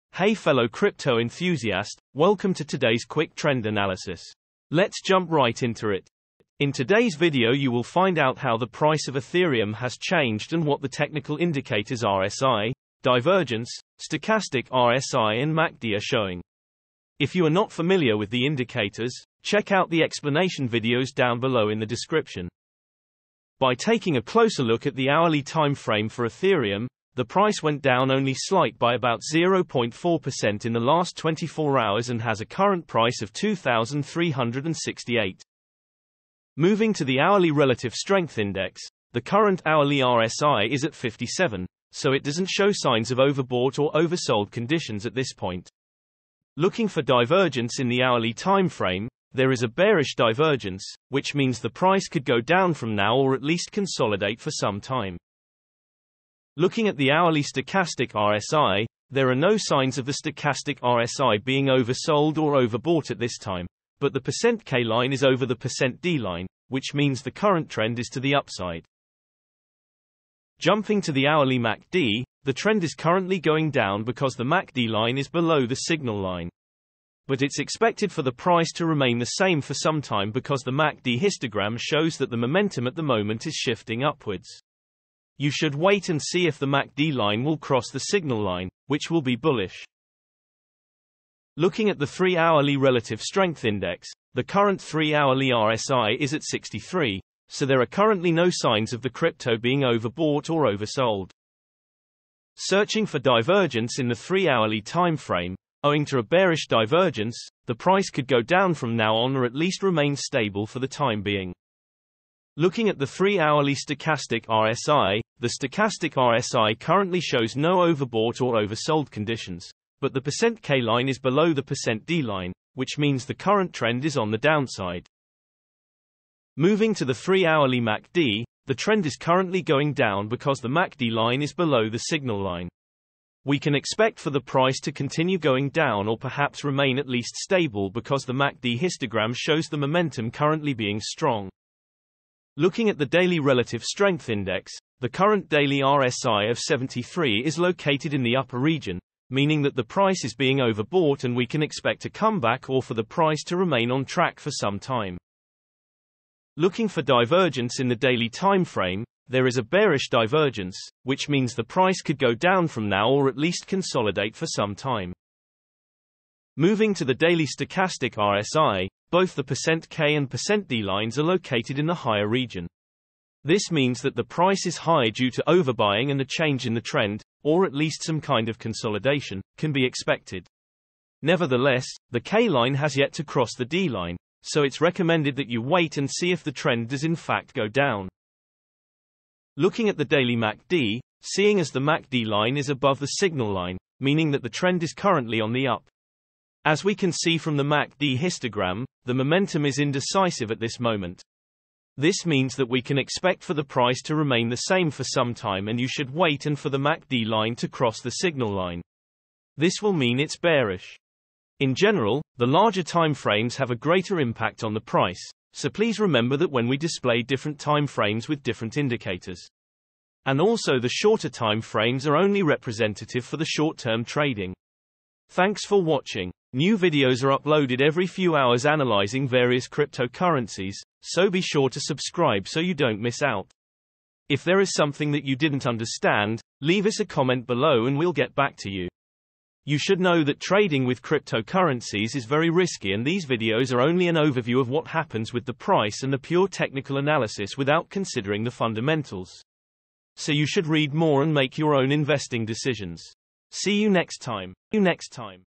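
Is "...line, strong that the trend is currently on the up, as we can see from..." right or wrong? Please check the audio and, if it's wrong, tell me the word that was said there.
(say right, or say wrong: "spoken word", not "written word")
wrong: "meaning", not "strong".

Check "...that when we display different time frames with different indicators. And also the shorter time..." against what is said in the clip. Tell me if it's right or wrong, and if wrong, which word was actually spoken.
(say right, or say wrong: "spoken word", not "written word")
right.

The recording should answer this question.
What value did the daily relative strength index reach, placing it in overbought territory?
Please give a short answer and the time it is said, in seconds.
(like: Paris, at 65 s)
73, at 146 s.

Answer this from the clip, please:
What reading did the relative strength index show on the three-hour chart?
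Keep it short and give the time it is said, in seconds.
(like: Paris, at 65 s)
63, at 96 s.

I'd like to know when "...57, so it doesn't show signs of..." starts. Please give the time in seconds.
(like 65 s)
40 s.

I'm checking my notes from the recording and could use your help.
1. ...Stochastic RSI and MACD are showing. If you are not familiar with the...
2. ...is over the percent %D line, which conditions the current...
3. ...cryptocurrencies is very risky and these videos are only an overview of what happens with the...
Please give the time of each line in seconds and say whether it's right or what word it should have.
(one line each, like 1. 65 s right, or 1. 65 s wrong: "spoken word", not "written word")
1. 14 s right
2. 65 s wrong: "means", not "conditions"
3. 241 s right.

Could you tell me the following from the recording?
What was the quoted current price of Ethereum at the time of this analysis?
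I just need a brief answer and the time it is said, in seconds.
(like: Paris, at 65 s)
2,368, at 33 s.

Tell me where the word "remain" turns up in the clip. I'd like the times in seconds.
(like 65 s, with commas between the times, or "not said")
78 s, 109 s, 136 s, 153 s, 204 s.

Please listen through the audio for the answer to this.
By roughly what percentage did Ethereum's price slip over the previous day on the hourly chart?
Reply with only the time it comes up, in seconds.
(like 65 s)
29 s.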